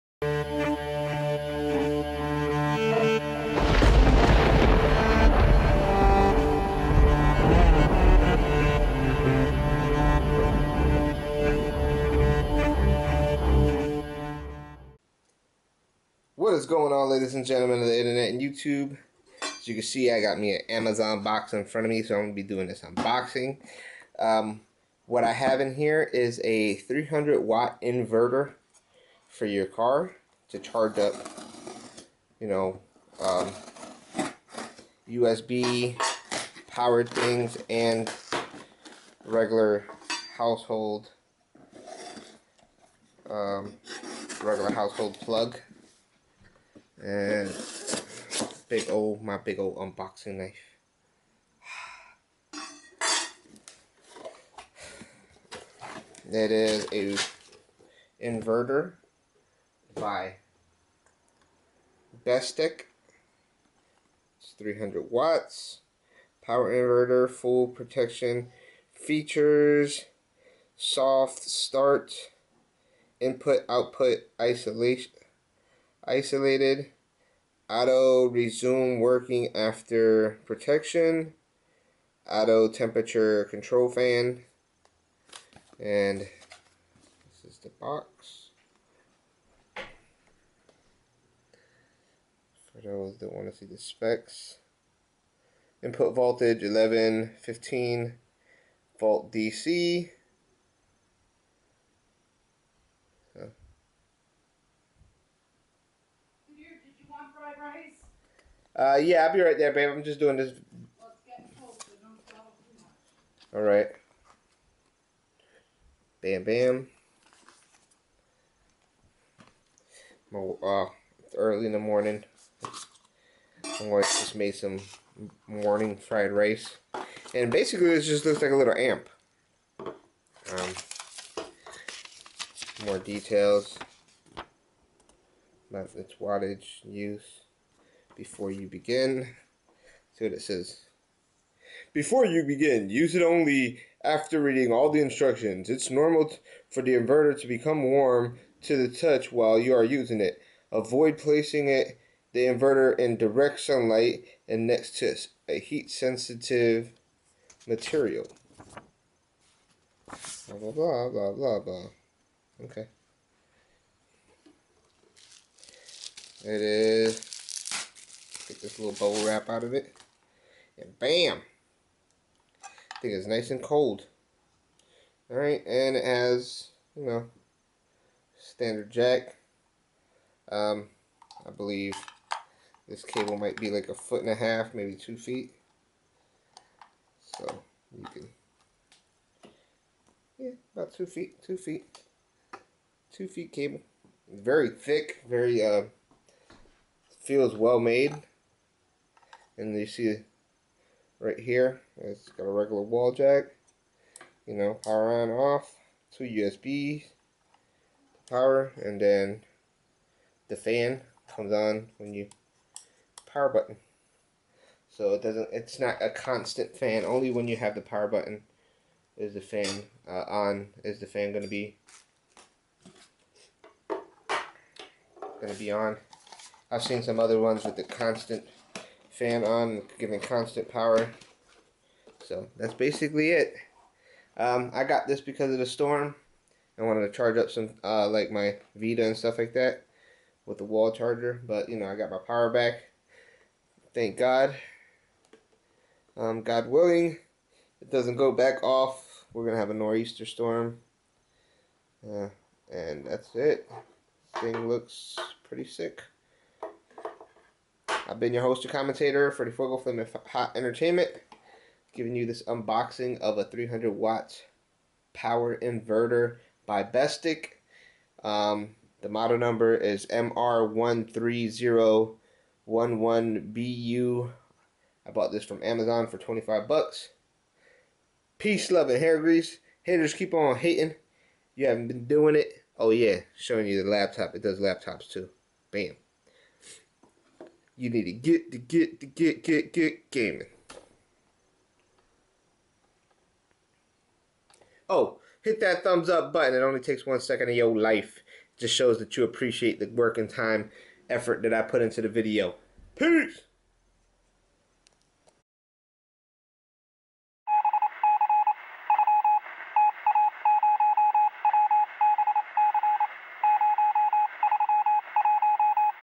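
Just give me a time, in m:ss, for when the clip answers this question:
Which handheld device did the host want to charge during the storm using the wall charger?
3:58.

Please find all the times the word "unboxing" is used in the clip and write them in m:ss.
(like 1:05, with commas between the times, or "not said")
0:22, 0:49, 4:22.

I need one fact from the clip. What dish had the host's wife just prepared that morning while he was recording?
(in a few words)
fried rice.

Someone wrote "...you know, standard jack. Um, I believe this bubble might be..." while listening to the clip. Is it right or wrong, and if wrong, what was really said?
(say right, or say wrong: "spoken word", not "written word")
wrong: "cable", not "bubble".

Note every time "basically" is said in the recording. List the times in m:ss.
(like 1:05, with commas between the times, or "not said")
2:07, 3:52.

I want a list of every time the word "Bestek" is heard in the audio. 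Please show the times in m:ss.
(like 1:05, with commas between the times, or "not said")
1:02, 4:26.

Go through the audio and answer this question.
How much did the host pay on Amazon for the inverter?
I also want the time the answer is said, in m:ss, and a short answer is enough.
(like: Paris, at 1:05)
$25, at 4:36.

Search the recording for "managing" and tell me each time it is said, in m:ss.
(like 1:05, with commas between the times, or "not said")
not said.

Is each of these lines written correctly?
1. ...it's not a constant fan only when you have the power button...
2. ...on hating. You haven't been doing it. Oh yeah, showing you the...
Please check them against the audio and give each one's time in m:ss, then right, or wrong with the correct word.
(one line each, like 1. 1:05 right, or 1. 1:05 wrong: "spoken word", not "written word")
1. 3:35 right
2. 4:40 right.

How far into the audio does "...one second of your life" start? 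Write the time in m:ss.
4:57.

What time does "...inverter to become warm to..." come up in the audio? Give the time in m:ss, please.
2:26.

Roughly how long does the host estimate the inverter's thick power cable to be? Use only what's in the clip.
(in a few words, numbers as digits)
2 feet.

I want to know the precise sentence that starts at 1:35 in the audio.
Input voltage 11, 15 volt DC.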